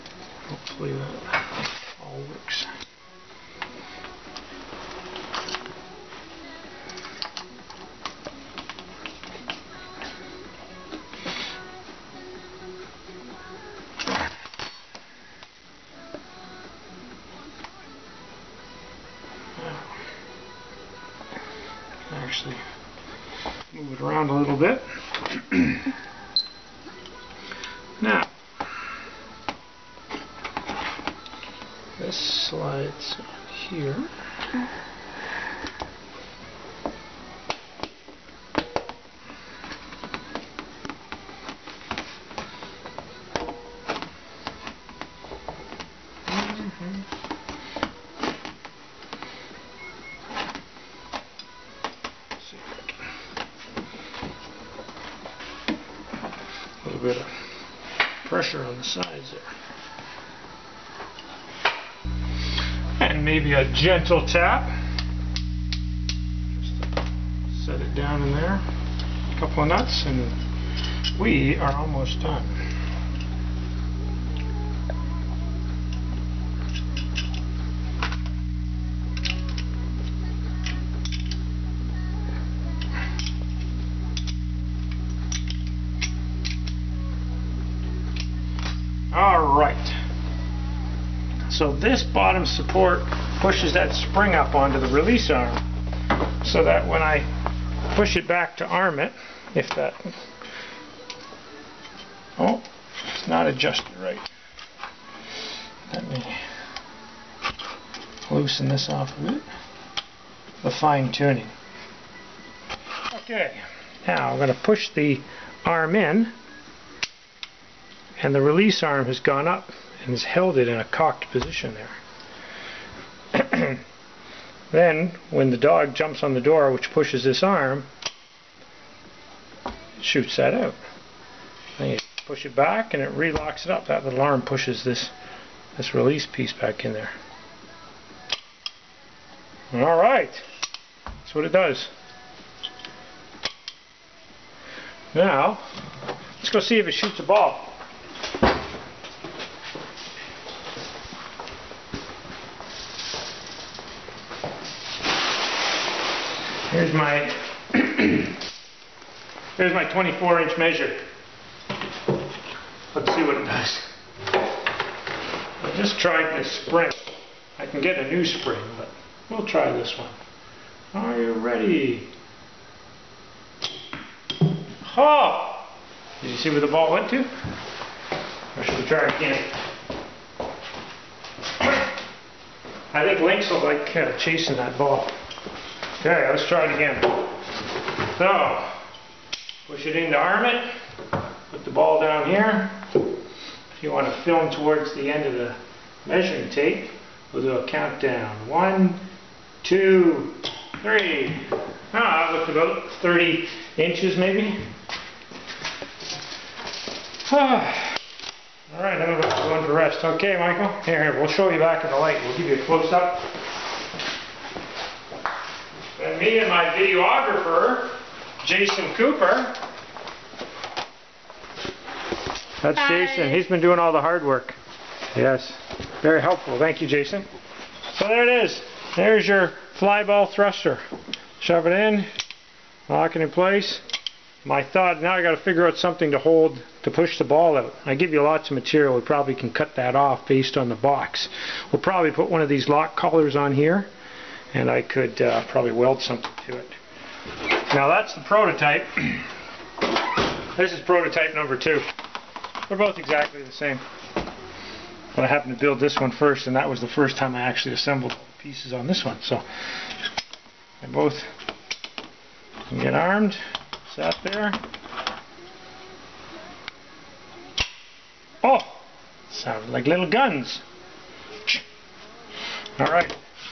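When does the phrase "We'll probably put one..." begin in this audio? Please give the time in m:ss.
4:01.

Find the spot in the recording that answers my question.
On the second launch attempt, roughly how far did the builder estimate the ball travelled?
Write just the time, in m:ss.
3:23.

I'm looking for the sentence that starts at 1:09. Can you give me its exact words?
A couple of nuts and we are almost done.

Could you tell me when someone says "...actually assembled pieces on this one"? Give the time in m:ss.
4:17.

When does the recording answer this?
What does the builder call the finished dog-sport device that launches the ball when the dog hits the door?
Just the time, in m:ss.
3:49.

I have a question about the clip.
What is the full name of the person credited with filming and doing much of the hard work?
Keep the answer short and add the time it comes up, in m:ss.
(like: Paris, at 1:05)
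Jason Cooper, at 3:38.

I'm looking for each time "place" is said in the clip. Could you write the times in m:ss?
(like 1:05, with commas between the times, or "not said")
3:53.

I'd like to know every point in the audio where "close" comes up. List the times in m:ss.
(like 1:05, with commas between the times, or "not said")
3:32.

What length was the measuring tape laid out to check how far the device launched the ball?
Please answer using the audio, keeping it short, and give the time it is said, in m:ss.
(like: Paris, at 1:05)
24 inch, at 2:39.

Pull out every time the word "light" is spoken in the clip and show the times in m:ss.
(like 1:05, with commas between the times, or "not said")
3:31.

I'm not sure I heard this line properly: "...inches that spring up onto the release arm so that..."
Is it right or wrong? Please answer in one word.
wrong.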